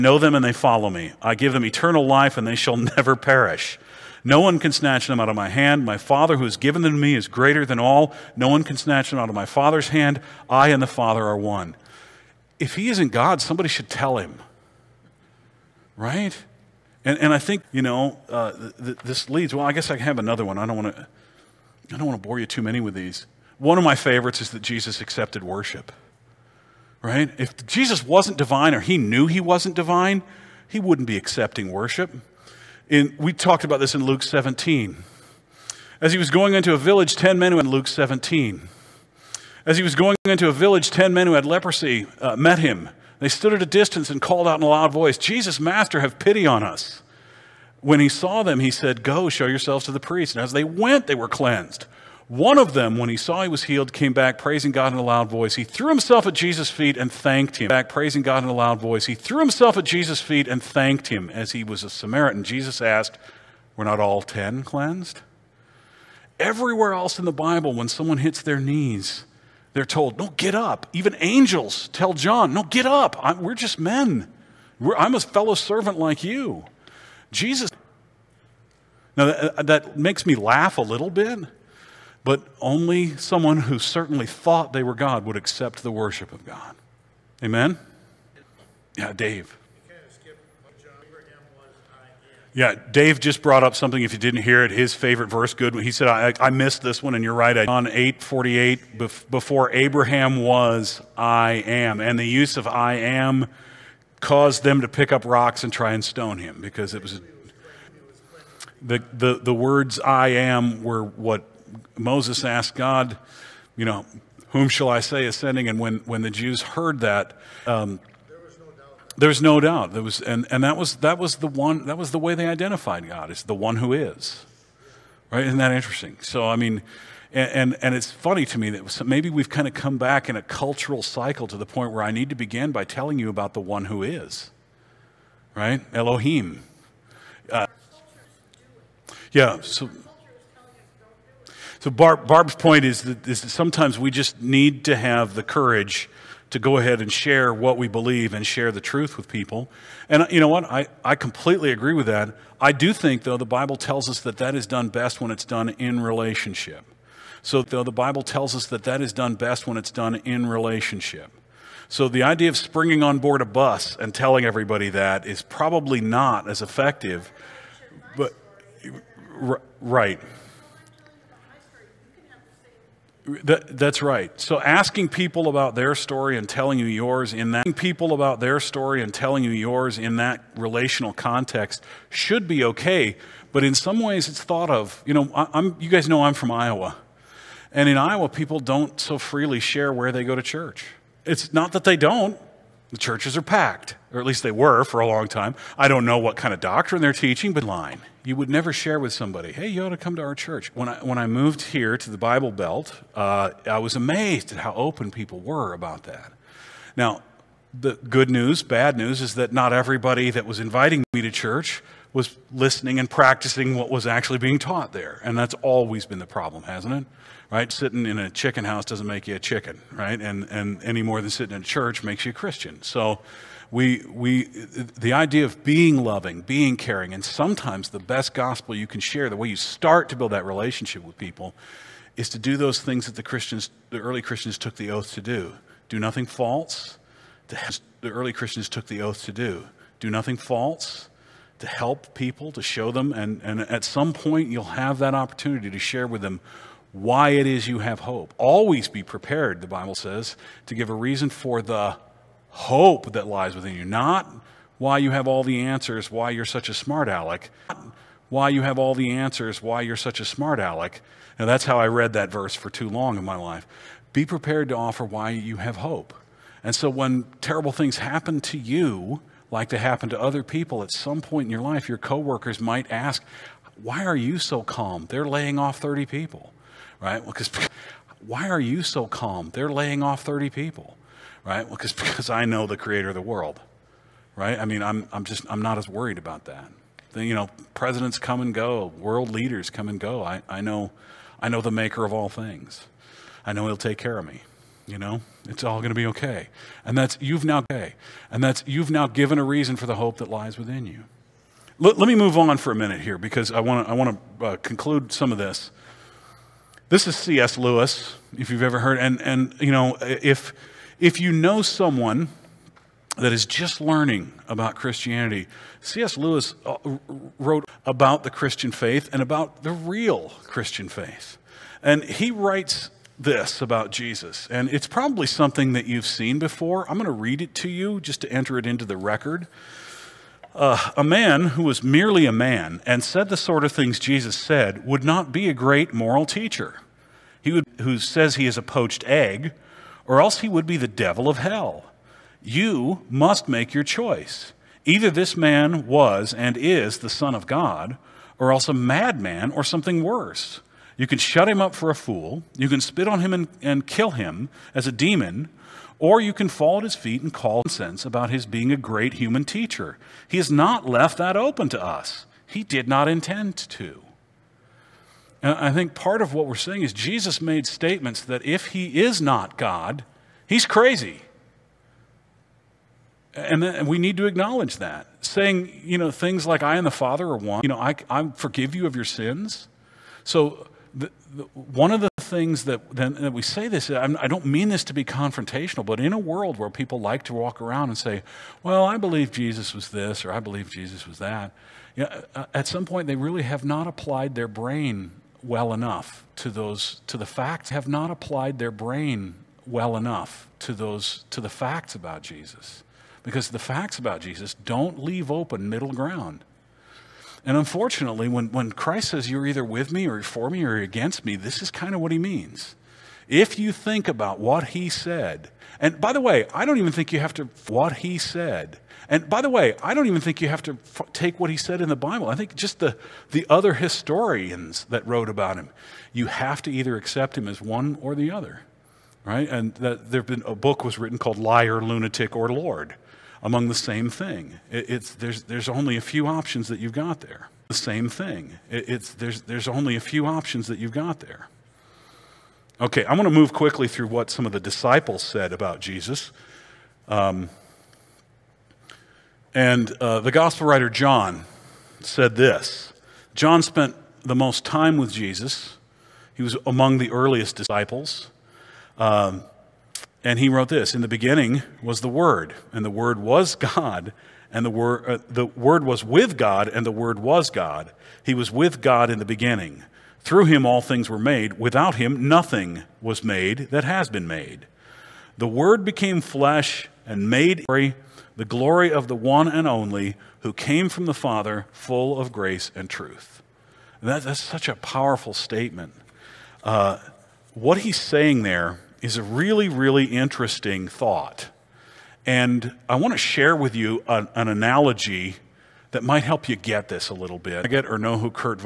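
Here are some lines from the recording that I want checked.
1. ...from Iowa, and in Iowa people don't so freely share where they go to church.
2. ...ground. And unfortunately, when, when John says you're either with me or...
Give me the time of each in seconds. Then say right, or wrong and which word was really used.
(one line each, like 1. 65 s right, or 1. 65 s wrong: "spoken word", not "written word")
1. 186 s right
2. 405 s wrong: "Christ", not "John".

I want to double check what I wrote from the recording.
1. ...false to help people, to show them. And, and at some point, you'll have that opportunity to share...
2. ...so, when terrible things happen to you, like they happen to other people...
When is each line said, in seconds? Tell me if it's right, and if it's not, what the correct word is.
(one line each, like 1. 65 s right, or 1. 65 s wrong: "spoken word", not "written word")
1. 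240 s right
2. 266 s right.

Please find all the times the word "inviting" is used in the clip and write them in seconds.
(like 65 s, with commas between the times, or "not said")
210 s.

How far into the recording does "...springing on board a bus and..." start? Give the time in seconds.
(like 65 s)
162 s.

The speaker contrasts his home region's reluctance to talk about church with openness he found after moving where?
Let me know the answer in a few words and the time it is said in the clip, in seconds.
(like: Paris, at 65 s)
The Bible Belt, at 202 s.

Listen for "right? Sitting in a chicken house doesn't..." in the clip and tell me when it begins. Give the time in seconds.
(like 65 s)
217 s.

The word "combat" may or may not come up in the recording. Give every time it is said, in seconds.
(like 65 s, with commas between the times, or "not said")
not said.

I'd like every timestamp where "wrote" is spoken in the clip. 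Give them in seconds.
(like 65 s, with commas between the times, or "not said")
317 s, 425 s, 460 s.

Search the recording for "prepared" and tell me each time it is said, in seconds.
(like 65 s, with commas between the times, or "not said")
249 s, 264 s.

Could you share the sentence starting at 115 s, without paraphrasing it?
And when, when the Jews heard that, um, was no doubt.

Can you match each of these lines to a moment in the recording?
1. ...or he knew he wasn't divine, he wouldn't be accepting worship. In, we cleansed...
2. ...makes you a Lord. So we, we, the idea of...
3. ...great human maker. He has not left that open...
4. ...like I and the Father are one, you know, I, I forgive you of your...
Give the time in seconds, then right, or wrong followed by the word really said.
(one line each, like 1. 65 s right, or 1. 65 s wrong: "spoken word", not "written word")
1. 28 s wrong: "talked", not "cleansed"
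2. 222 s wrong: "Christian", not "Lord"
3. 358 s wrong: "teacher", not "maker"
4. 376 s right.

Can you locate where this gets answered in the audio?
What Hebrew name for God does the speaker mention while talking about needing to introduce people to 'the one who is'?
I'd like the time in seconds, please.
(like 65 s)
135 s.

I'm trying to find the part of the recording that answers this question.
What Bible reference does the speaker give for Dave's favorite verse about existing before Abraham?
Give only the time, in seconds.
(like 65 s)
97 s.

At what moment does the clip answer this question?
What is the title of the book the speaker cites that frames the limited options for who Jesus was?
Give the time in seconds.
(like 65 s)
431 s.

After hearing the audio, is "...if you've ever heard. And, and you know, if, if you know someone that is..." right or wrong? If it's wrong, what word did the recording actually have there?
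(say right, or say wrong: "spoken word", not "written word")
right.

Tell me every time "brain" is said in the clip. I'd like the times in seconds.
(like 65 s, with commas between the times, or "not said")
394 s, 398 s.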